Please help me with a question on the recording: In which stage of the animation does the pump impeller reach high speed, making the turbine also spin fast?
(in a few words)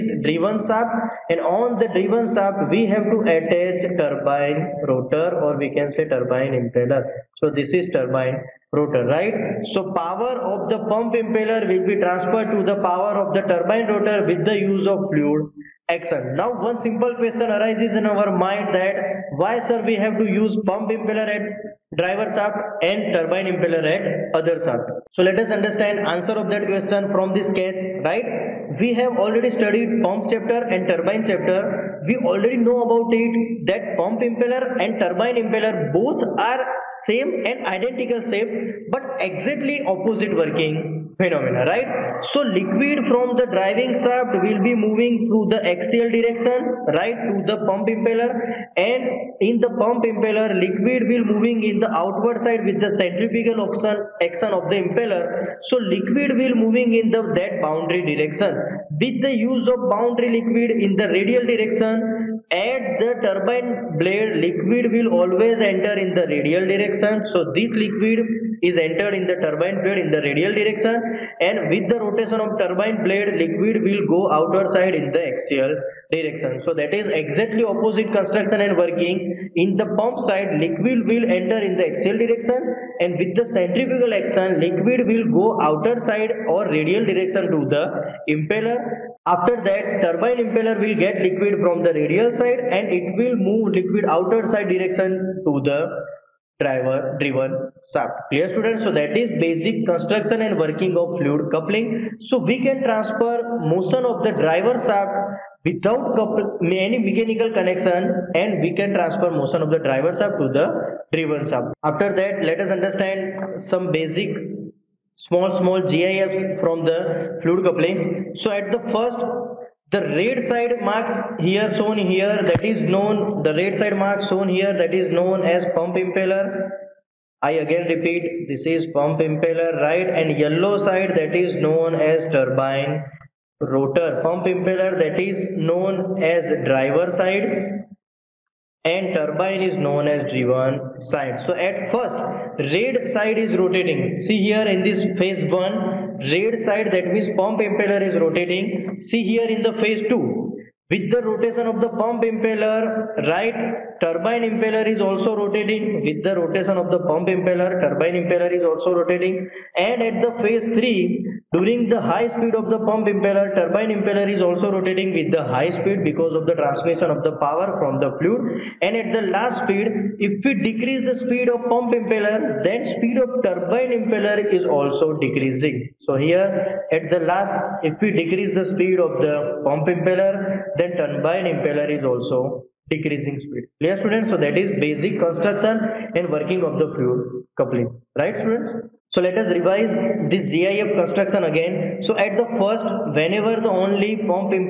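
Phase 3.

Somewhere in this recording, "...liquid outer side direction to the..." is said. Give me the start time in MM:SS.
01:33.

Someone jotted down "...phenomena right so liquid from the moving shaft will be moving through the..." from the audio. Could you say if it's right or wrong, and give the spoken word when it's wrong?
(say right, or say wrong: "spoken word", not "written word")
wrong: "driving", not "moving".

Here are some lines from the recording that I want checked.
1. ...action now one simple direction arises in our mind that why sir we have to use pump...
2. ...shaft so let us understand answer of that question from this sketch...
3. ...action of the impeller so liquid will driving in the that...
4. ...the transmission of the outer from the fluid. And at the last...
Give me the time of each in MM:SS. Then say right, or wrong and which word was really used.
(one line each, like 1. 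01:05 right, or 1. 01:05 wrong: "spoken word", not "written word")
1. 00:15 wrong: "question", not "direction"
2. 00:24 right
3. 00:54 wrong: "moving", not "driving"
4. 02:46 wrong: "power", not "outer".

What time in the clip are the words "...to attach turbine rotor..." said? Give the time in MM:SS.
00:03.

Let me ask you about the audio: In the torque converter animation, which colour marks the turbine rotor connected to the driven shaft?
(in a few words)
Yellow.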